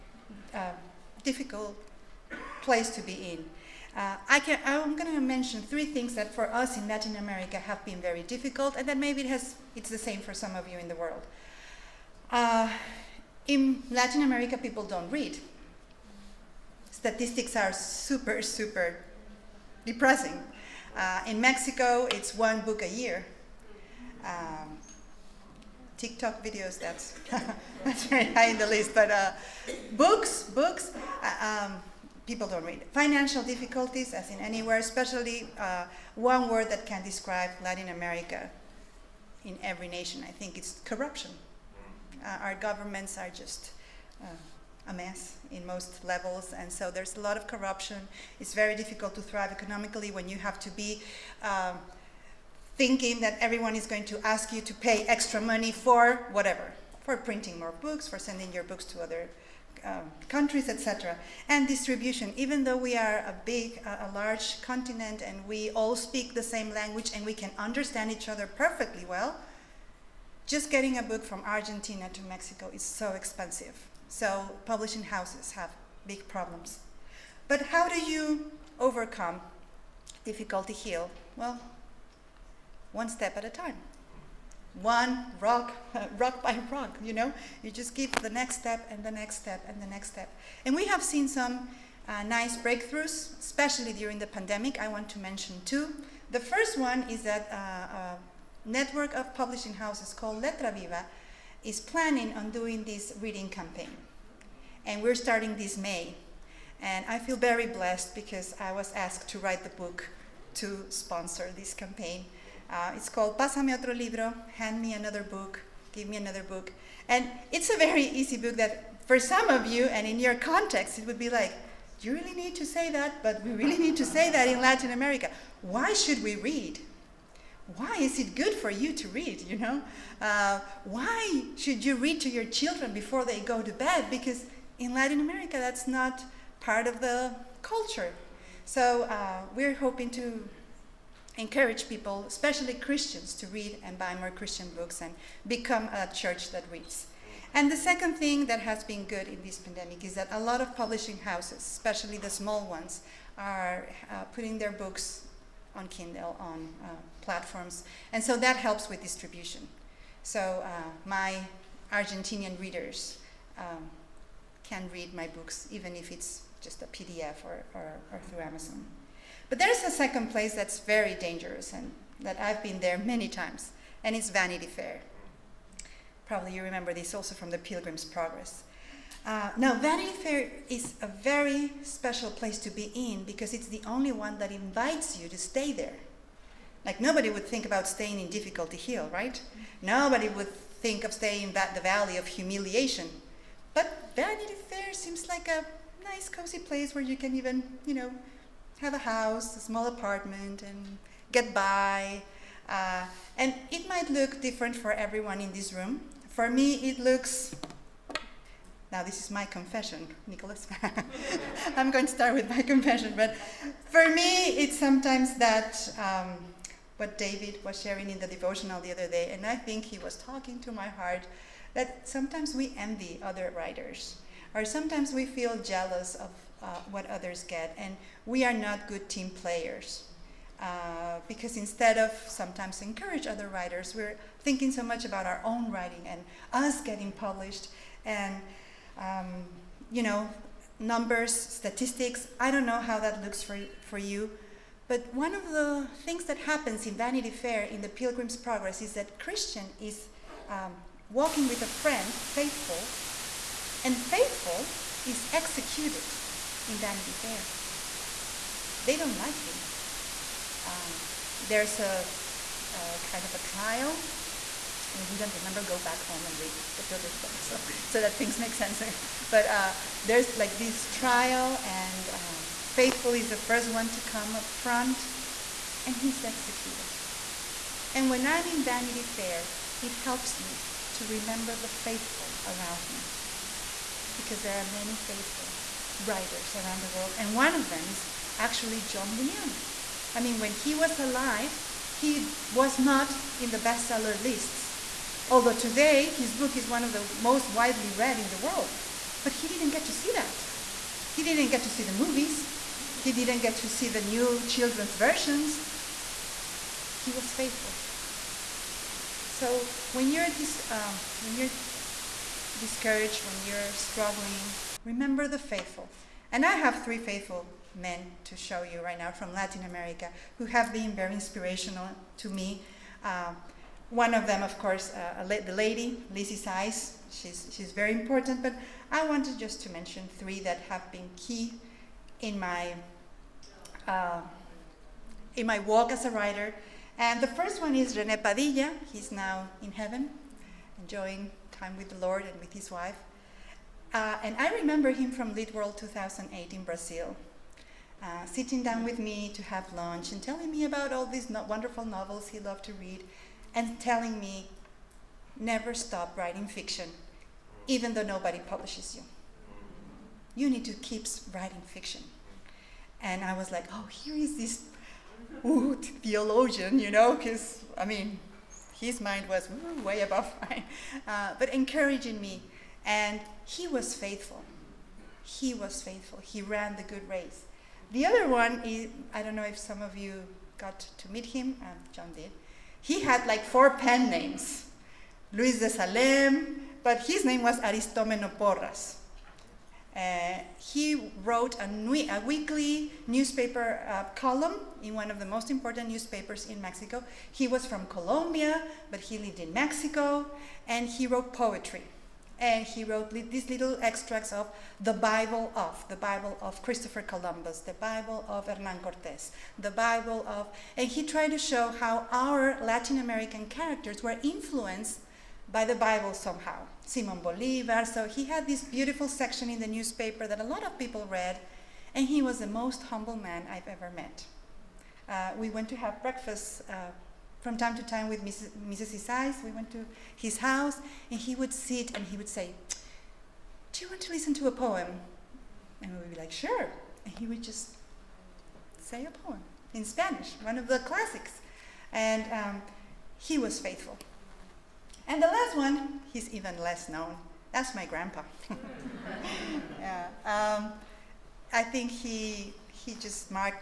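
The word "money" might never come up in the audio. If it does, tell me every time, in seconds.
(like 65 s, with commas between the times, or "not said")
55 s.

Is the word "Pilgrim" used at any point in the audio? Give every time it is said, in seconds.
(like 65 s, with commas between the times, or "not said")
177 s, 247 s, 266 s.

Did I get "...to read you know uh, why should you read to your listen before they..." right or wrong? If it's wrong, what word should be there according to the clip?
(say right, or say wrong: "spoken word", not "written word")
wrong: "children", not "listen".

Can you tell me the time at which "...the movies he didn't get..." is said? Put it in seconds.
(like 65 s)
301 s.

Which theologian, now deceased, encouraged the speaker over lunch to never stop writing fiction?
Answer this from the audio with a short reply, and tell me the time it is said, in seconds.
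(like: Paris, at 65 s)
René Padilla, at 337 s.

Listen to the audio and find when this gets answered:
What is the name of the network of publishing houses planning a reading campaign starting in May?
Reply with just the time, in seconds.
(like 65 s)
100 s.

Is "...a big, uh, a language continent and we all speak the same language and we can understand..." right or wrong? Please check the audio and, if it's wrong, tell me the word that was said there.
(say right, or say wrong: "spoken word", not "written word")
wrong: "large", not "language".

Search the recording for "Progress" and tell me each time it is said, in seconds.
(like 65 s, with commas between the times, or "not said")
178 s, 248 s, 267 s.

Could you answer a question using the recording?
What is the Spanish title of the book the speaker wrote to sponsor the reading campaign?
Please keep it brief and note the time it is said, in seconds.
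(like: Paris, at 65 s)
Pásame otro libro, at 113 s.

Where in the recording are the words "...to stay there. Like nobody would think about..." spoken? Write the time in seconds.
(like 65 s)
185 s.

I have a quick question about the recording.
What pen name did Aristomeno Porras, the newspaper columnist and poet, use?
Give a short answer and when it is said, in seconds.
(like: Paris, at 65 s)
Luis de Salem, at 385 s.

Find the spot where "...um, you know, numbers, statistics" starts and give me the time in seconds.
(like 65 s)
238 s.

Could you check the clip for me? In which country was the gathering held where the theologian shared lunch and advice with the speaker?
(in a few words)
Brazil.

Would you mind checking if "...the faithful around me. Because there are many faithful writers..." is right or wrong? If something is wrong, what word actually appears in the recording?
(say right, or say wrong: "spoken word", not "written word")
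right.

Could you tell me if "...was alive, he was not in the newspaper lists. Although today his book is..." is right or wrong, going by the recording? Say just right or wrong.
wrong.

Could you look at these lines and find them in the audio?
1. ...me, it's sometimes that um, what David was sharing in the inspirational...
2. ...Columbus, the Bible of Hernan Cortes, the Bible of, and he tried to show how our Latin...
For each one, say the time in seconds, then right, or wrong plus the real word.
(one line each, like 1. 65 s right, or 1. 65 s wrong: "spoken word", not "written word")
1. 214 s wrong: "devotional", not "inspirational"
2. 407 s right.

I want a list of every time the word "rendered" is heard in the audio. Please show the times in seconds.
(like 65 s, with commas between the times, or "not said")
not said.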